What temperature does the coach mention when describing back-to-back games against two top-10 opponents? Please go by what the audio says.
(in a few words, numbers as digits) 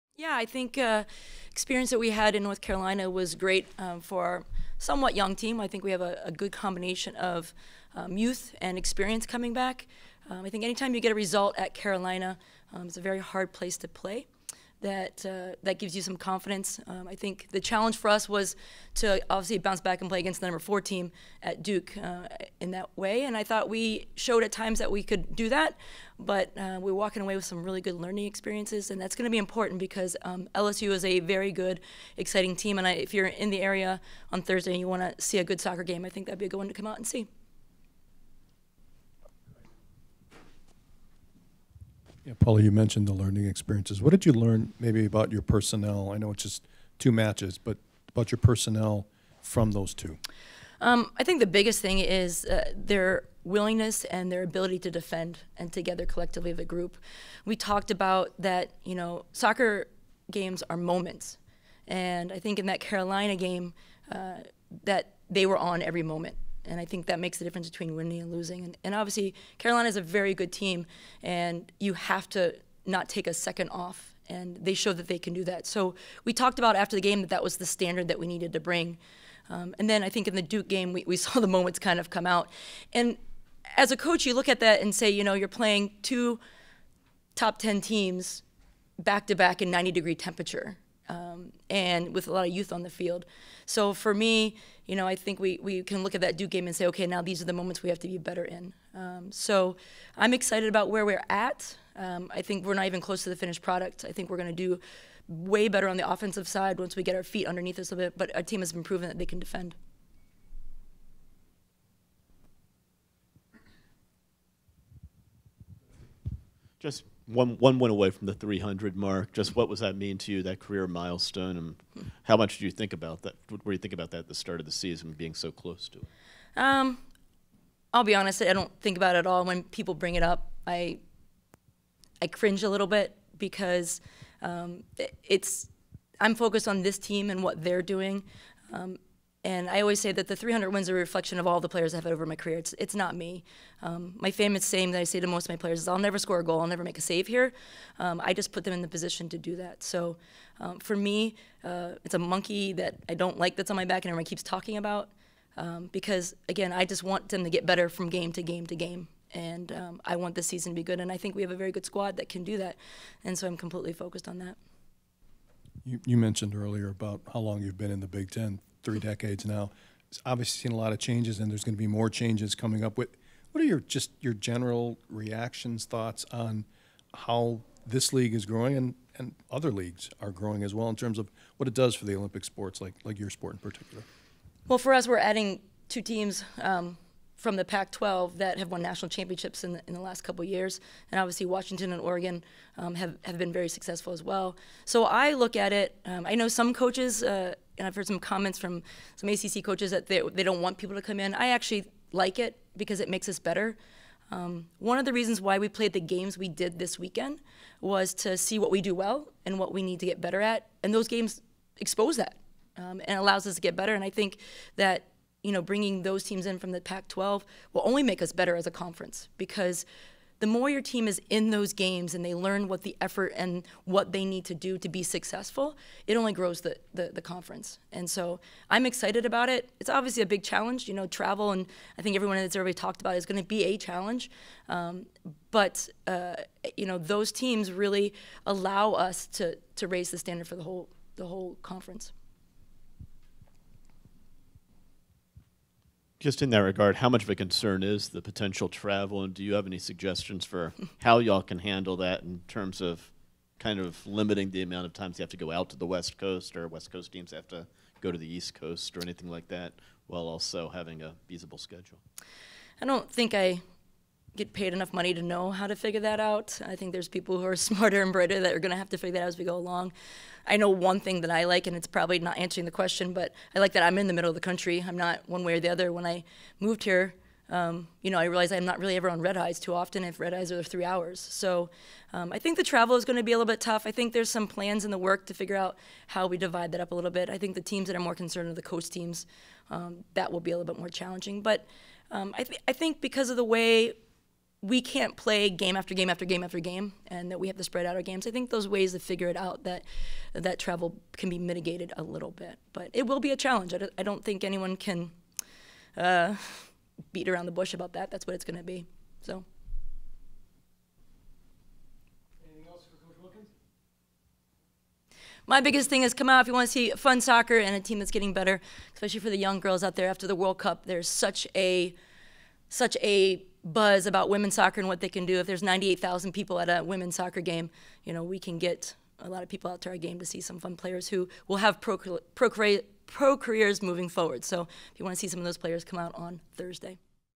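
90 degrees.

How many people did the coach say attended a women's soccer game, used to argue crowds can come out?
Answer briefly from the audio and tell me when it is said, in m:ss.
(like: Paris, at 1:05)
98,000, at 5:25.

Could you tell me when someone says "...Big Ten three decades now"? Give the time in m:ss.
2:48.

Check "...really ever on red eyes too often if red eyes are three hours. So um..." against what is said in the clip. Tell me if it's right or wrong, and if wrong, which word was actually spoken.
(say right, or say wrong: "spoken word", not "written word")
right.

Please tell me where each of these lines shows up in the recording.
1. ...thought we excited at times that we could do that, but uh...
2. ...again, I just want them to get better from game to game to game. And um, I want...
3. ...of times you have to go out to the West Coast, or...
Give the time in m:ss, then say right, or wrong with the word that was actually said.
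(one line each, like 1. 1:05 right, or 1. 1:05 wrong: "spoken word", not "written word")
1. 0:23 wrong: "showed", not "excited"
2. 2:36 right
3. 4:14 right.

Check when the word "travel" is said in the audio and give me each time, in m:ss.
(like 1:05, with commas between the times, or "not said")
3:51, 4:08, 4:42, 5:00.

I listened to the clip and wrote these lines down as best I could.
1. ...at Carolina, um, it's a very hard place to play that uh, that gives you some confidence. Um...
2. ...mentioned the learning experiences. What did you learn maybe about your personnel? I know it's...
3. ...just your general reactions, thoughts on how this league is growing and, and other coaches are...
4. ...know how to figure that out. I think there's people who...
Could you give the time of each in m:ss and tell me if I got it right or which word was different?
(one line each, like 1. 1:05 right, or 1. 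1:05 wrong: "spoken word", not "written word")
1. 0:11 right
2. 0:42 right
3. 2:53 wrong: "leagues", not "coaches"
4. 4:25 right.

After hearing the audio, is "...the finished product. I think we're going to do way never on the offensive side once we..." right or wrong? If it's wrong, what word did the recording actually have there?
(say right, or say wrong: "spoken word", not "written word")
wrong: "better", not "never".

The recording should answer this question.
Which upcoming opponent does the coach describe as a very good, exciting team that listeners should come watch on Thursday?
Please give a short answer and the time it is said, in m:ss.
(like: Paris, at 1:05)
LSU, at 0:30.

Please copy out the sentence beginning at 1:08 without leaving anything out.
And, and obviously, Carolina is a very good team, and you have to not take a second off.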